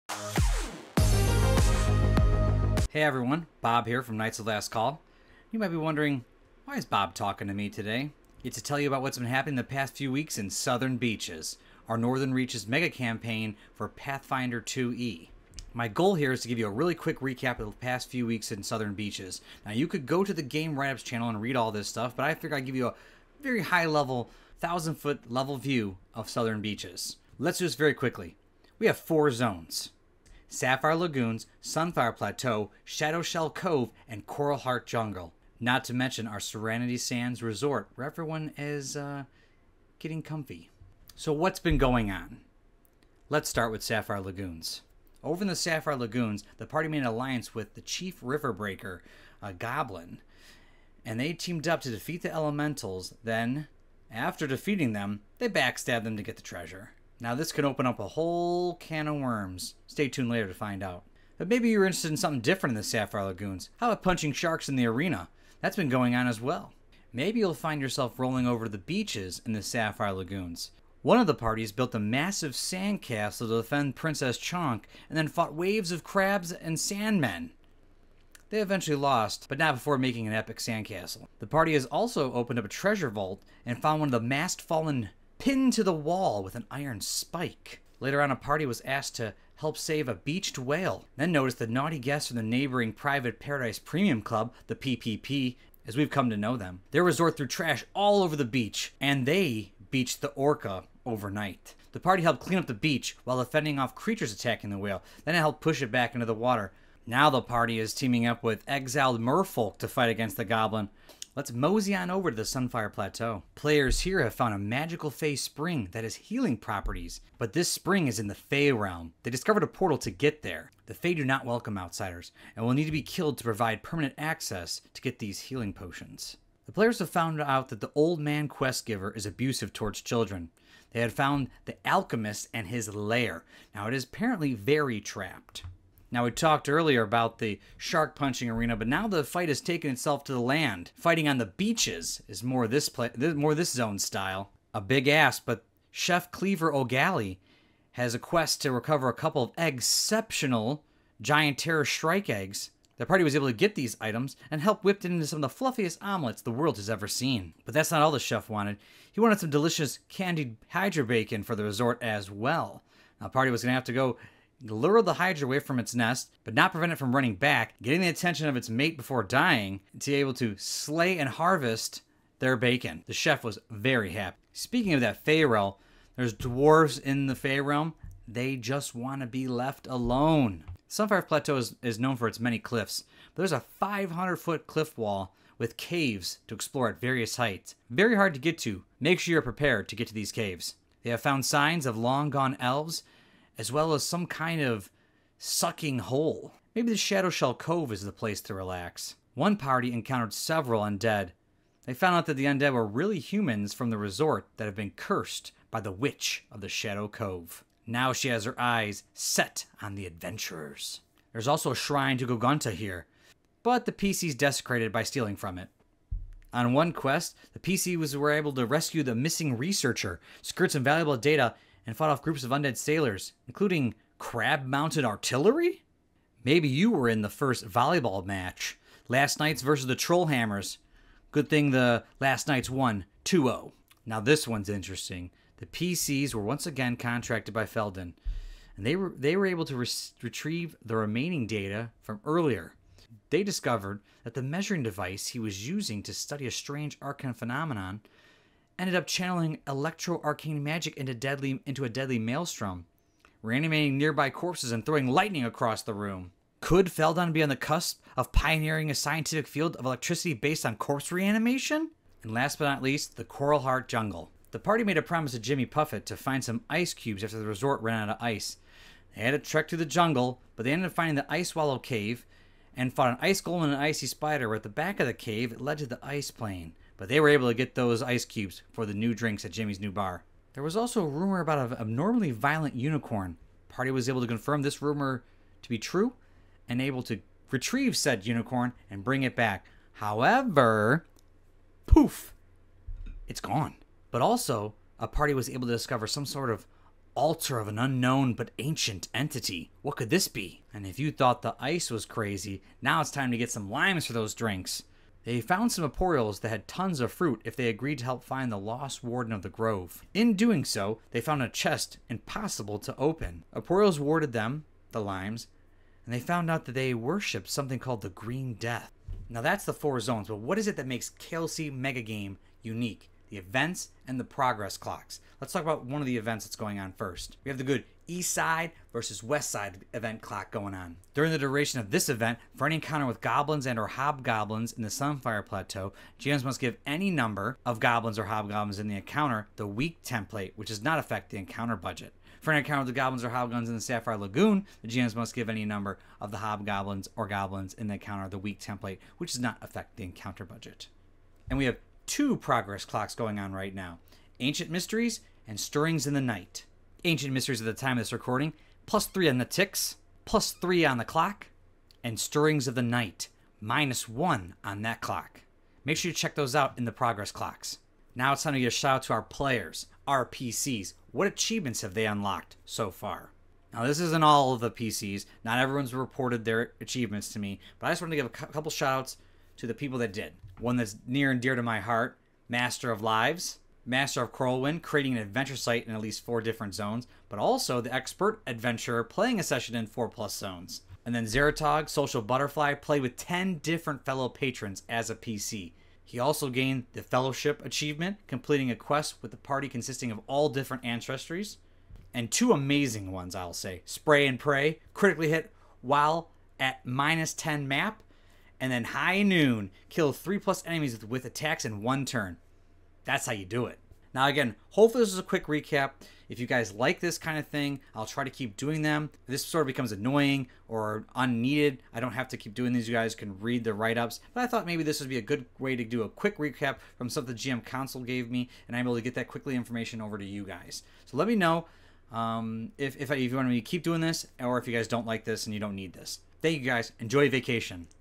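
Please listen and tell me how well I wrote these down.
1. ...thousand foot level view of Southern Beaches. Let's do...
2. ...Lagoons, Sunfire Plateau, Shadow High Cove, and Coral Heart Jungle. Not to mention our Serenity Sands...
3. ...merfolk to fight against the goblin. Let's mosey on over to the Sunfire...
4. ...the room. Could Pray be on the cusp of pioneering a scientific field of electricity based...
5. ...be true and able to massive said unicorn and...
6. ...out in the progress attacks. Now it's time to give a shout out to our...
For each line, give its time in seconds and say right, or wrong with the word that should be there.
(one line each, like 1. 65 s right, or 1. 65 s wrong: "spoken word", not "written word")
1. 24 s right
2. 30 s wrong: "Shell", not "High"
3. 109 s right
4. 255 s wrong: "Feldon", not "Pray"
5. 285 s wrong: "retrieve", not "massive"
6. 366 s wrong: "clocks", not "attacks".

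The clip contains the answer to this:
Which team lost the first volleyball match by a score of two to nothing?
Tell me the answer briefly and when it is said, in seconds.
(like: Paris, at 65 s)
Trollhammers, at 229 s.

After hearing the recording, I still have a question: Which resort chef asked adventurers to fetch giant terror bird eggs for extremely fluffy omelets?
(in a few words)
Cleaver O'Galley.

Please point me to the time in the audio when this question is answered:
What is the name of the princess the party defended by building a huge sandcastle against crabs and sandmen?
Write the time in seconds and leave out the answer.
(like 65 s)
73 s.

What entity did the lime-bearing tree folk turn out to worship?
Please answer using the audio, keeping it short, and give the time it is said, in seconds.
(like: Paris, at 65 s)
the Green Death, at 318 s.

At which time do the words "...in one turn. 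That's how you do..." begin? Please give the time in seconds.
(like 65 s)
411 s.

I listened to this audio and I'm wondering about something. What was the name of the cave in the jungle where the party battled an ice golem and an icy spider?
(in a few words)
Ice Swallow Cave.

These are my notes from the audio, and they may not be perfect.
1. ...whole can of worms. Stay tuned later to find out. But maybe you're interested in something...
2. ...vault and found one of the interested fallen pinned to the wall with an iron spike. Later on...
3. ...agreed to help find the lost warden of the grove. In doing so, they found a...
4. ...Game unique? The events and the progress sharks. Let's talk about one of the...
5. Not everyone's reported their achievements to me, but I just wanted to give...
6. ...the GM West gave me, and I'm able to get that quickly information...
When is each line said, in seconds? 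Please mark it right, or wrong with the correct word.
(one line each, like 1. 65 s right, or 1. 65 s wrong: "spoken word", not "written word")
1. 58 s right
2. 83 s wrong: "masked", not "interested"
3. 307 s right
4. 322 s wrong: "clocks", not "sharks"
5. 375 s right
6. 427 s wrong: "Council", not "West".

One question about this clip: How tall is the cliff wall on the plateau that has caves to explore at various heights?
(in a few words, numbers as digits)
500 feet.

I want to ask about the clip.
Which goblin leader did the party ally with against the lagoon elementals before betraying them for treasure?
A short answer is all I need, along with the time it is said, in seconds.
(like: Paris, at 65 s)
Chief River Breaker, at 47 s.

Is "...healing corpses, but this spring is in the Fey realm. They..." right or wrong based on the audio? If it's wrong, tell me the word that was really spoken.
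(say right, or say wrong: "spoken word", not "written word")
wrong: "properties", not "corpses".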